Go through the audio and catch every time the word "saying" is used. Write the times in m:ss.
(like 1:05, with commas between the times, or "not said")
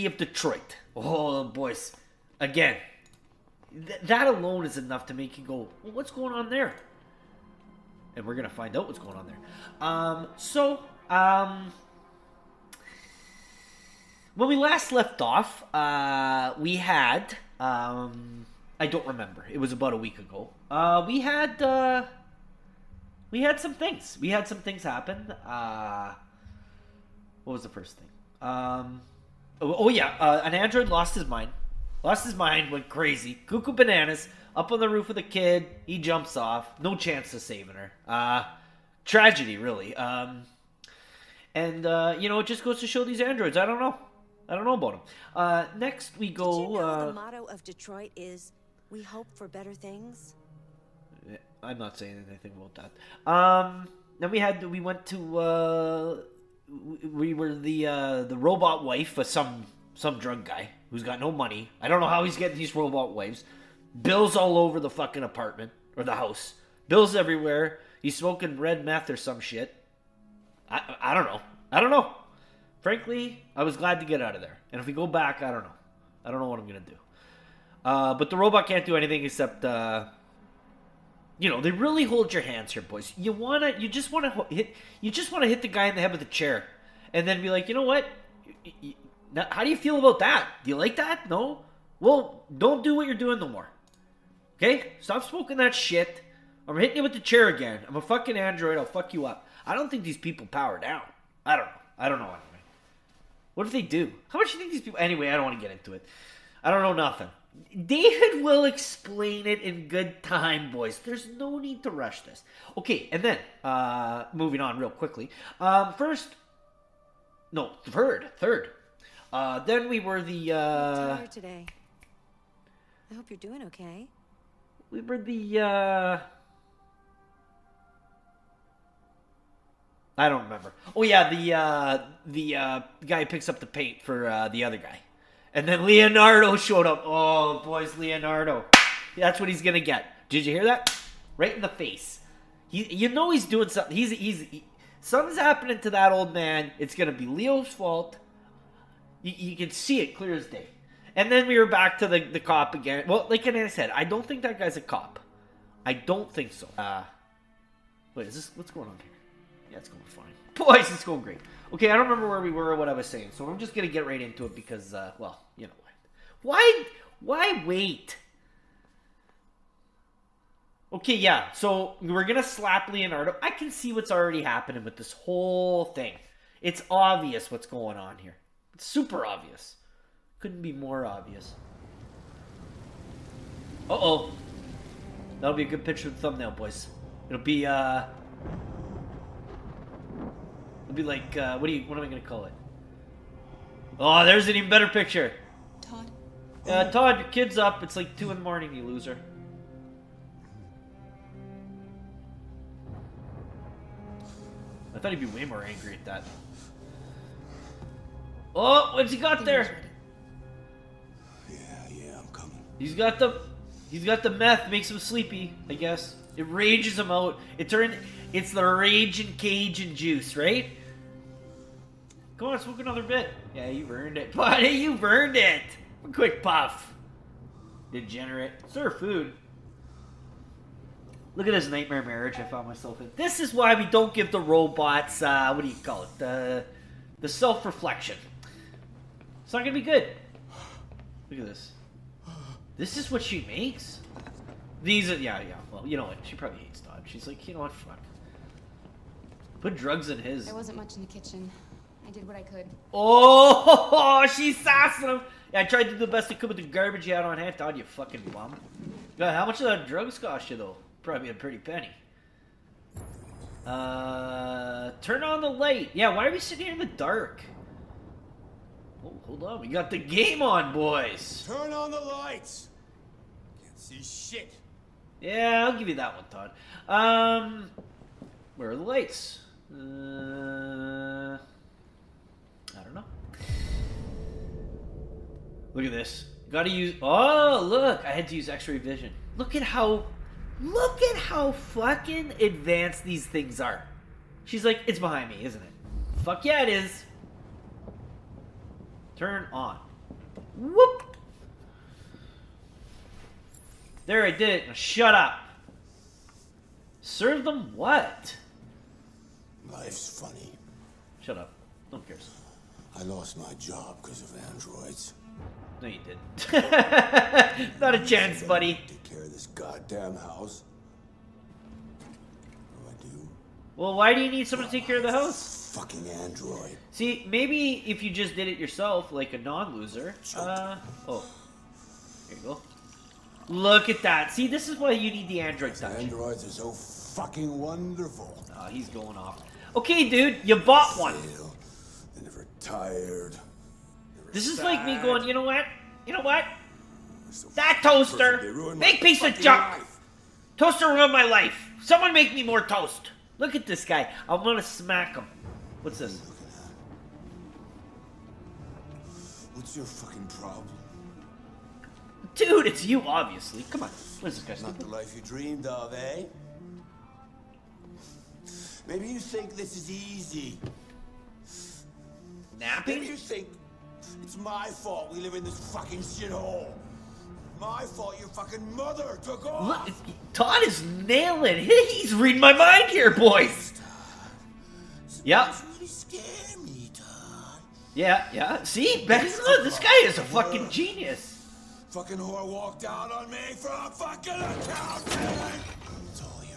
0:51, 2:43.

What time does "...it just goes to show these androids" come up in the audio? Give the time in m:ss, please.
0:42.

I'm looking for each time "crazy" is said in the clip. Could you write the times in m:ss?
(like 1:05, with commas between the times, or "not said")
0:32.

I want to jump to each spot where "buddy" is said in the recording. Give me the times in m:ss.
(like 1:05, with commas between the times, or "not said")
3:44, 5:18.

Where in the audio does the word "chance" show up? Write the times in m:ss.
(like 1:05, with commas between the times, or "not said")
0:36, 5:18.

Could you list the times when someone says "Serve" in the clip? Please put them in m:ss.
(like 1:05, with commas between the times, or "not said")
3:48, 5:07.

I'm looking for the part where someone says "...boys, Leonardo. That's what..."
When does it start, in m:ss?
2:17.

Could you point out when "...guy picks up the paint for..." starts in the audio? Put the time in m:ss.
2:13.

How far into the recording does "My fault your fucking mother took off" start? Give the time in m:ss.
6:17.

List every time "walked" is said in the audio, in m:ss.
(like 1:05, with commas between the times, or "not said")
6:32.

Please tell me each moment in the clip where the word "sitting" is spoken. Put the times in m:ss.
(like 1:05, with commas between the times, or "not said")
4:26.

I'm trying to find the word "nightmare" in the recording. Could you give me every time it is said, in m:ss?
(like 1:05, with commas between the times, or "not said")
3:51.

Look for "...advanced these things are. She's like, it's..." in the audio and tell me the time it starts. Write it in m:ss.
4:52.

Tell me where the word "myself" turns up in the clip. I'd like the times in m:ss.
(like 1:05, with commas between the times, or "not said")
3:52.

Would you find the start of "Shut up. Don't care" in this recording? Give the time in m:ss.
5:11.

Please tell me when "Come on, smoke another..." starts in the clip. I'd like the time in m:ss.
3:42.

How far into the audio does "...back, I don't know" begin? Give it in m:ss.
1:15.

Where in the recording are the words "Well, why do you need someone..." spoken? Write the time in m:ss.
5:23.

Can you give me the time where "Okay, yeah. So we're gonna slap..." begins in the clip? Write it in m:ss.
2:50.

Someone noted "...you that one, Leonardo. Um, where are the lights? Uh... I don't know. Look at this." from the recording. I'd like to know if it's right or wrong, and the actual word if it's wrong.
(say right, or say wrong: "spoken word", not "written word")
wrong: "Todd", not "Leonardo".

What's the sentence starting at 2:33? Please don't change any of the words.
Well, like I said, I don't think that guy's a cop.